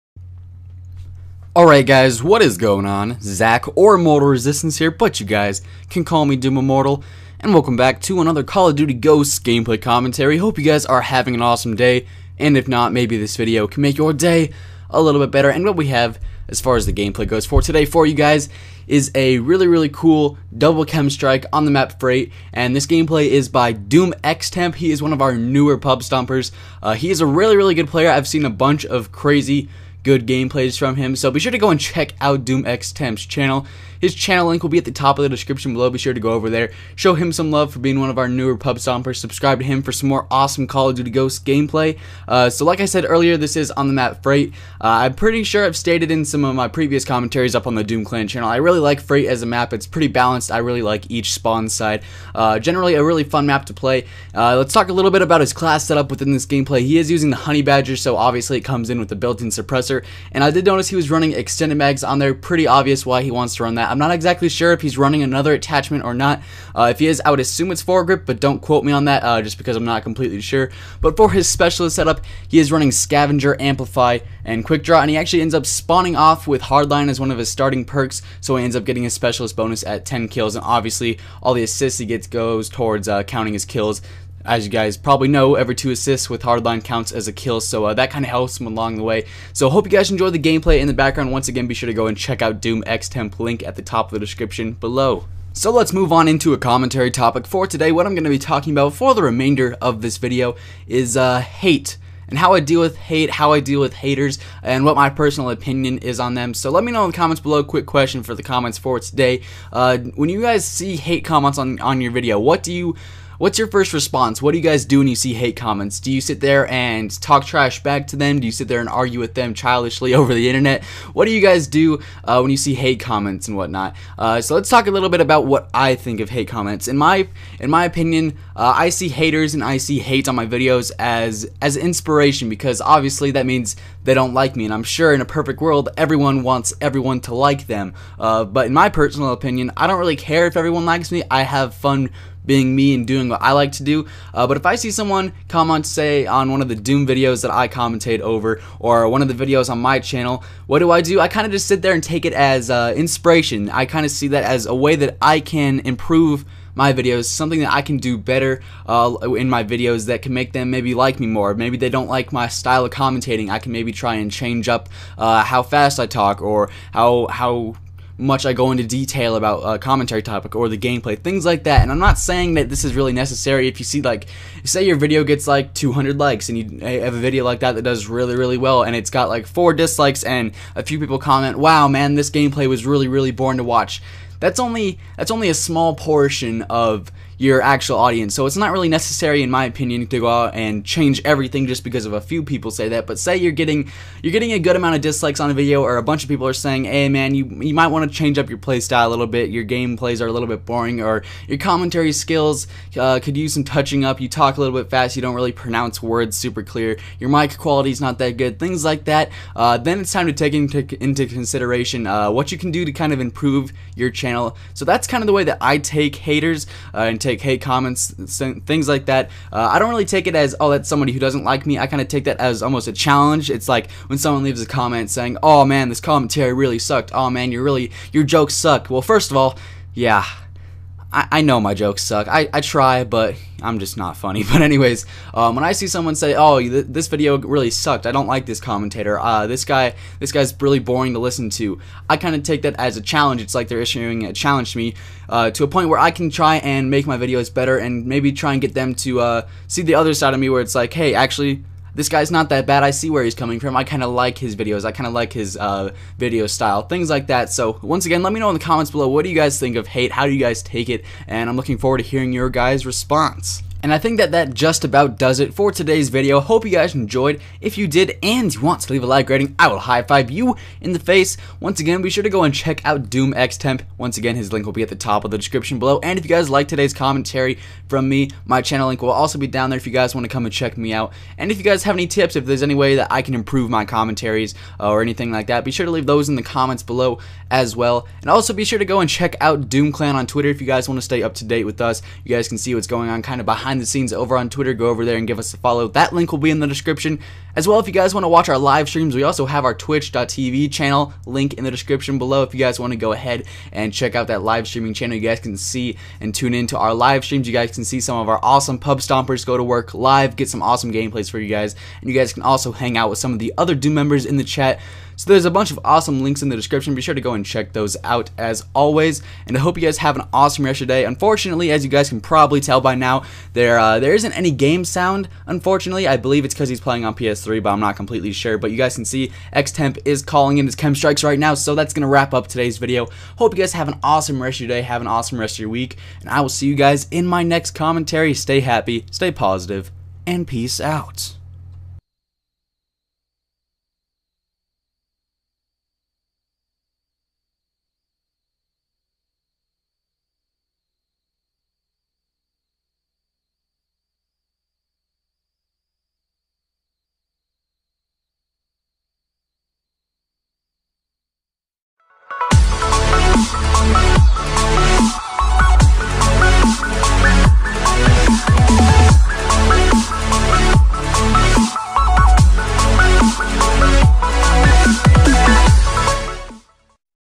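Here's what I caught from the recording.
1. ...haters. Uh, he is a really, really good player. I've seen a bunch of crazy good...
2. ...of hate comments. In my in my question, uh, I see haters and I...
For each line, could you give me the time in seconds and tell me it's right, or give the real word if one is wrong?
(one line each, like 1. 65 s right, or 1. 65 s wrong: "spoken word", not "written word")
1. 25 s wrong: "stompers", not "haters"
2. 126 s wrong: "opinion", not "question".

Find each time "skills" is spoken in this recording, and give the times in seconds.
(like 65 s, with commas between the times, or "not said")
202 s.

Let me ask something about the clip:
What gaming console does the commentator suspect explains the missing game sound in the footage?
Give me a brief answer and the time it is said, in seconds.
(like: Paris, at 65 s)
PS3, at 327 s.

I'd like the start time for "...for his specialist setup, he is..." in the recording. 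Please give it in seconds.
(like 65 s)
71 s.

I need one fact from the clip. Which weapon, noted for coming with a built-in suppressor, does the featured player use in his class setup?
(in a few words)
Honey Badger.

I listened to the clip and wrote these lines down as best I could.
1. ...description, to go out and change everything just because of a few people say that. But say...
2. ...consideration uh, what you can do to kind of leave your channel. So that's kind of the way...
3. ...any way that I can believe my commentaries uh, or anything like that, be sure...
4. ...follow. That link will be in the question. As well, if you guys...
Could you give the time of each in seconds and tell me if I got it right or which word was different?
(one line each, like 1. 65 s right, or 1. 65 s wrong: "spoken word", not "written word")
1. 189 s wrong: "opinion", not "description"
2. 211 s wrong: "improve", not "leave"
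3. 282 s wrong: "improve", not "believe"
4. 295 s wrong: "description", not "question".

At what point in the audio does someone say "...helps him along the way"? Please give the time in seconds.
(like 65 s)
88 s.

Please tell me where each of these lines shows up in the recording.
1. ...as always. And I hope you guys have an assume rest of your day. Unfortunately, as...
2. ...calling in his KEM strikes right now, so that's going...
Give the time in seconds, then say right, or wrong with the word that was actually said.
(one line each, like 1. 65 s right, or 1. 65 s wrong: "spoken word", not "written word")
1. 318 s wrong: "awesome", not "assume"
2. 330 s right.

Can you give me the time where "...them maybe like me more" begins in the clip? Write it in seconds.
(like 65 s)
160 s.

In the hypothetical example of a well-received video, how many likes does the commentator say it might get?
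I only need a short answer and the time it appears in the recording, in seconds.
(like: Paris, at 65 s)
200, at 175 s.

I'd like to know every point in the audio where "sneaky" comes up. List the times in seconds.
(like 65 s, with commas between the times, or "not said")
not said.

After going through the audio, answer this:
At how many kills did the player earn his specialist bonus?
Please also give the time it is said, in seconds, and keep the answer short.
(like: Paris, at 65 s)
10, at 80 s.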